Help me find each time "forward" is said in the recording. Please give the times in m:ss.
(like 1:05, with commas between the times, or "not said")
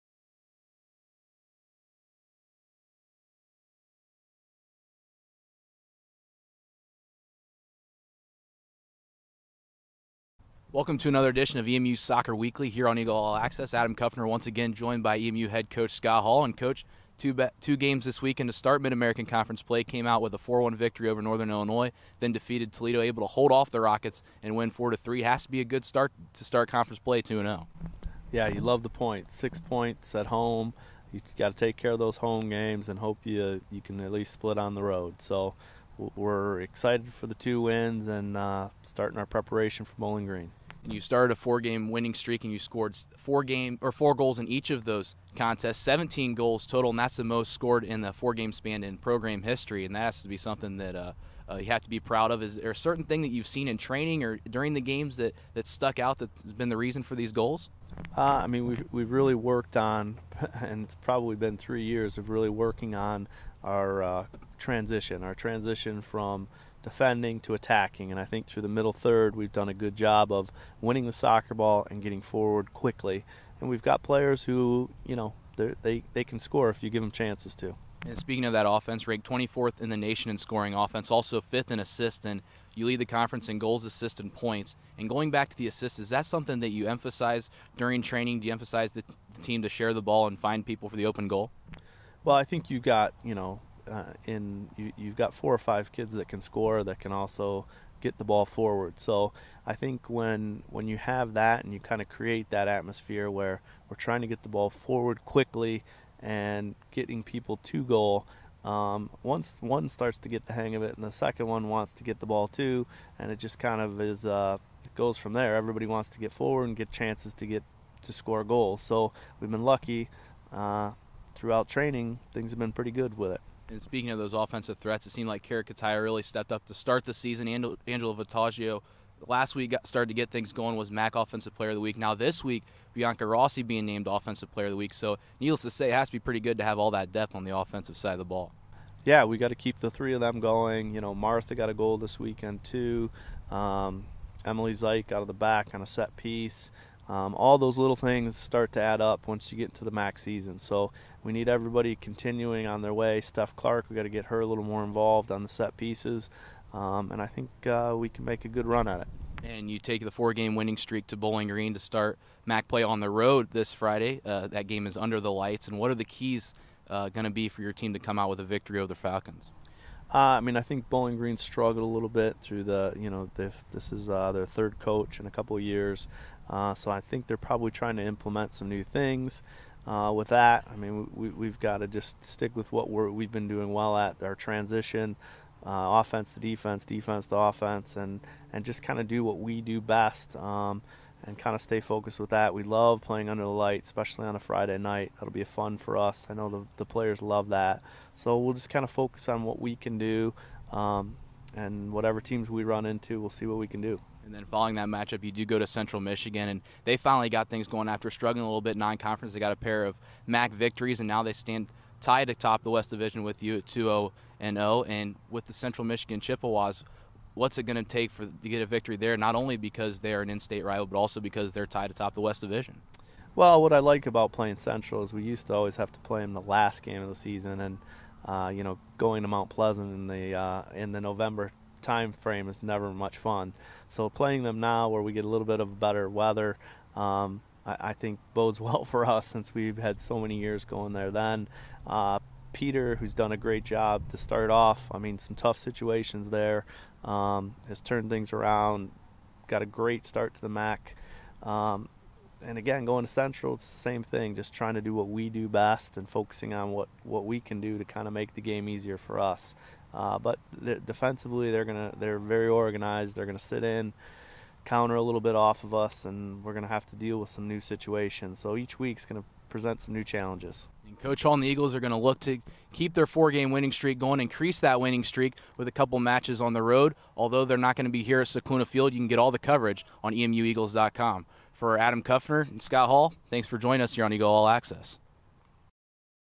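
1:12, 1:38, 1:44, 1:56.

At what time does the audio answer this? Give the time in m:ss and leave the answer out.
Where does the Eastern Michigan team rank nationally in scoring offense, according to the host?
1:19.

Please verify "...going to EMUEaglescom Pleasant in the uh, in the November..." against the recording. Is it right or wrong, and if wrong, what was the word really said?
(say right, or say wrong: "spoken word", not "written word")
wrong: "Mount", not "EMUEaglescom".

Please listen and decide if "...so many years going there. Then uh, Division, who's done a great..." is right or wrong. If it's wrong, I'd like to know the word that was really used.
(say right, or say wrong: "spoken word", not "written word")
wrong: "Peter", not "Division".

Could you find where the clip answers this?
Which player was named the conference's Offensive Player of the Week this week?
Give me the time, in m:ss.
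2:12.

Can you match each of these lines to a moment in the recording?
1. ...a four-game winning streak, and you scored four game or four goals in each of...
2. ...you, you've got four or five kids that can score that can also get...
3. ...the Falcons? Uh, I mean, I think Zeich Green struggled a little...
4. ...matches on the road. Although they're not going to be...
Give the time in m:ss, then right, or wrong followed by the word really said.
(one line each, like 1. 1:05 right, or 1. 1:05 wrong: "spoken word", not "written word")
1. 0:41 right
2. 1:34 right
3. 2:48 wrong: "Bowling", not "Zeich"
4. 4:35 right.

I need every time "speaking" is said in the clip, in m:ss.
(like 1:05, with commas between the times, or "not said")
1:18, 2:03.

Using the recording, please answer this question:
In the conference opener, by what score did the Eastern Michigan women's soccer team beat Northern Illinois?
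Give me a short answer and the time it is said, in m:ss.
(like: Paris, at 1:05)
4-1, at 0:20.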